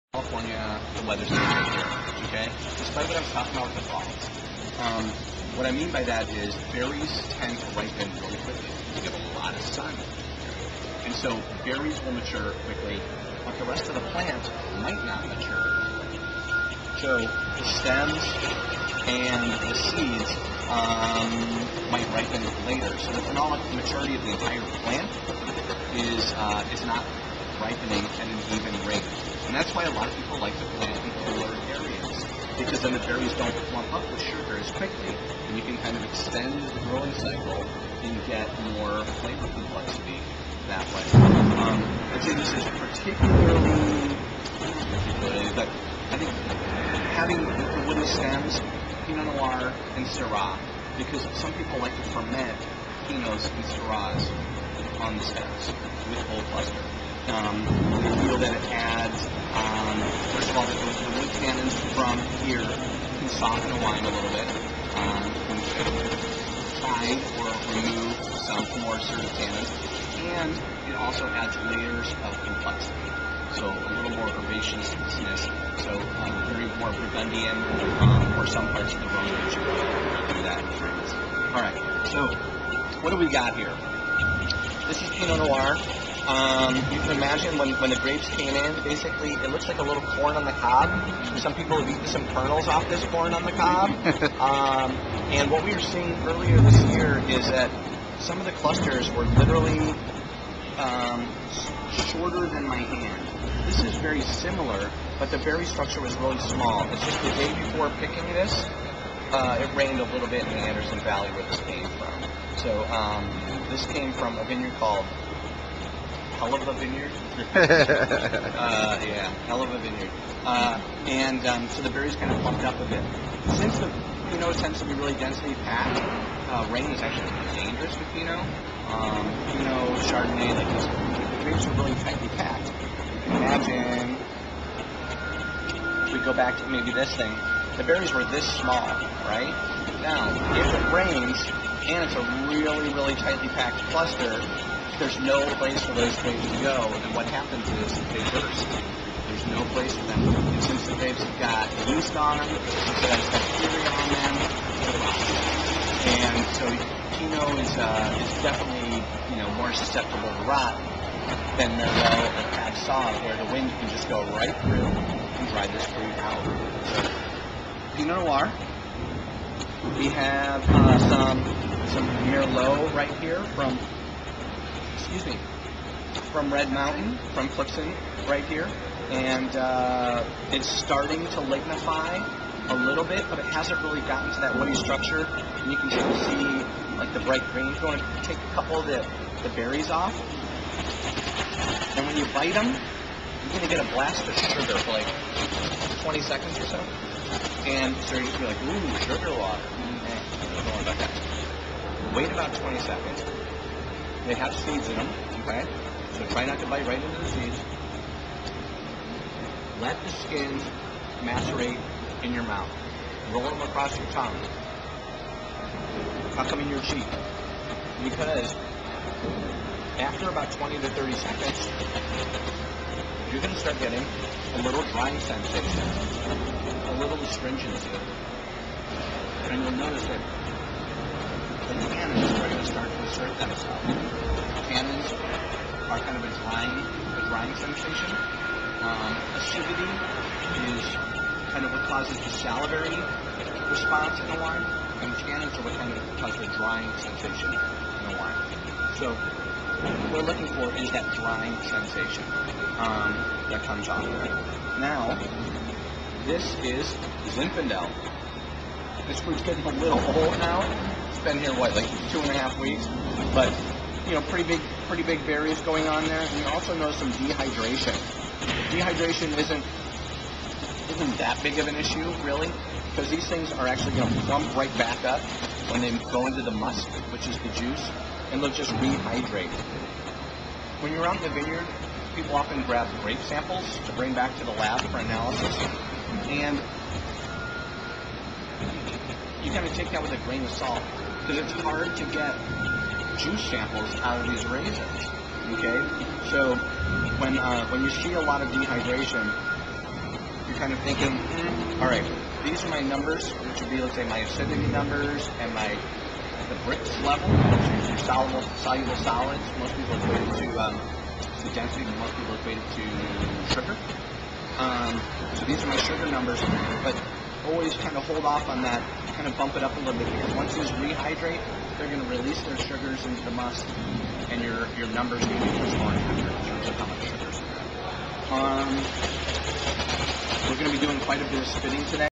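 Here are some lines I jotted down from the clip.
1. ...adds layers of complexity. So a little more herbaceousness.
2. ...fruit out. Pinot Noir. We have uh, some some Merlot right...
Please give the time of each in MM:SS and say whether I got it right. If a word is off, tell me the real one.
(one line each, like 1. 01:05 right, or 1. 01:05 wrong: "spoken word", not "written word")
1. 01:11 right
2. 02:45 right.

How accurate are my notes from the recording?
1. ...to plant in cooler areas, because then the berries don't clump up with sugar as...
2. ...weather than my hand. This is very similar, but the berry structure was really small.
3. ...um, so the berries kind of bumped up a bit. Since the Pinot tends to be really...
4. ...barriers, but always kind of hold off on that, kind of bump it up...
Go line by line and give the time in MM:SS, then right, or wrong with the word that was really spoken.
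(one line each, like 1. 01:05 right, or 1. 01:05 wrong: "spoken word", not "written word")
1. 00:30 right
2. 01:42 wrong: "shorter", not "weather"
3. 02:01 right
4. 05:16 wrong: "numbers", not "barriers".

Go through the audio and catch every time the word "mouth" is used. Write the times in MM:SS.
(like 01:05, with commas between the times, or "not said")
03:32.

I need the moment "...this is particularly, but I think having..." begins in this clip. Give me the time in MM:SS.
00:42.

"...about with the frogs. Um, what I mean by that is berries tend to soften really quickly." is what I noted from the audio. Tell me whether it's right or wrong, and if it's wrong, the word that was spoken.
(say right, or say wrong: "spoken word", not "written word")
wrong: "ripen", not "soften".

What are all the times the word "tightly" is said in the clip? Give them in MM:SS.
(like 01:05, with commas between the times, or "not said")
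02:12, 02:23.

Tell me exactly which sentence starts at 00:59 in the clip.
Um, first of all, the, the wood tannins from here can soften the wine a little bit.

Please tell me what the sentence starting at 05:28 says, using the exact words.
Um, we're going to be doing quite a bit of spinning today.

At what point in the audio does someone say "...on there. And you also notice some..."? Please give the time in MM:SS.
04:25.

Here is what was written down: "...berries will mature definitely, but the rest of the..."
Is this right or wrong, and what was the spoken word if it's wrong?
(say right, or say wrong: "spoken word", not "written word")
wrong: "quickly", not "definitely".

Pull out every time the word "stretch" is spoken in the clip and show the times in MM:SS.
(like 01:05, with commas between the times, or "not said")
not said.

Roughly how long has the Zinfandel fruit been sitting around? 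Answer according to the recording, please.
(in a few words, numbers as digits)
2.5 weeks.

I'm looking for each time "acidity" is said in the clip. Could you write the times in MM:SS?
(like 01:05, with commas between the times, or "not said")
03:59, 05:04.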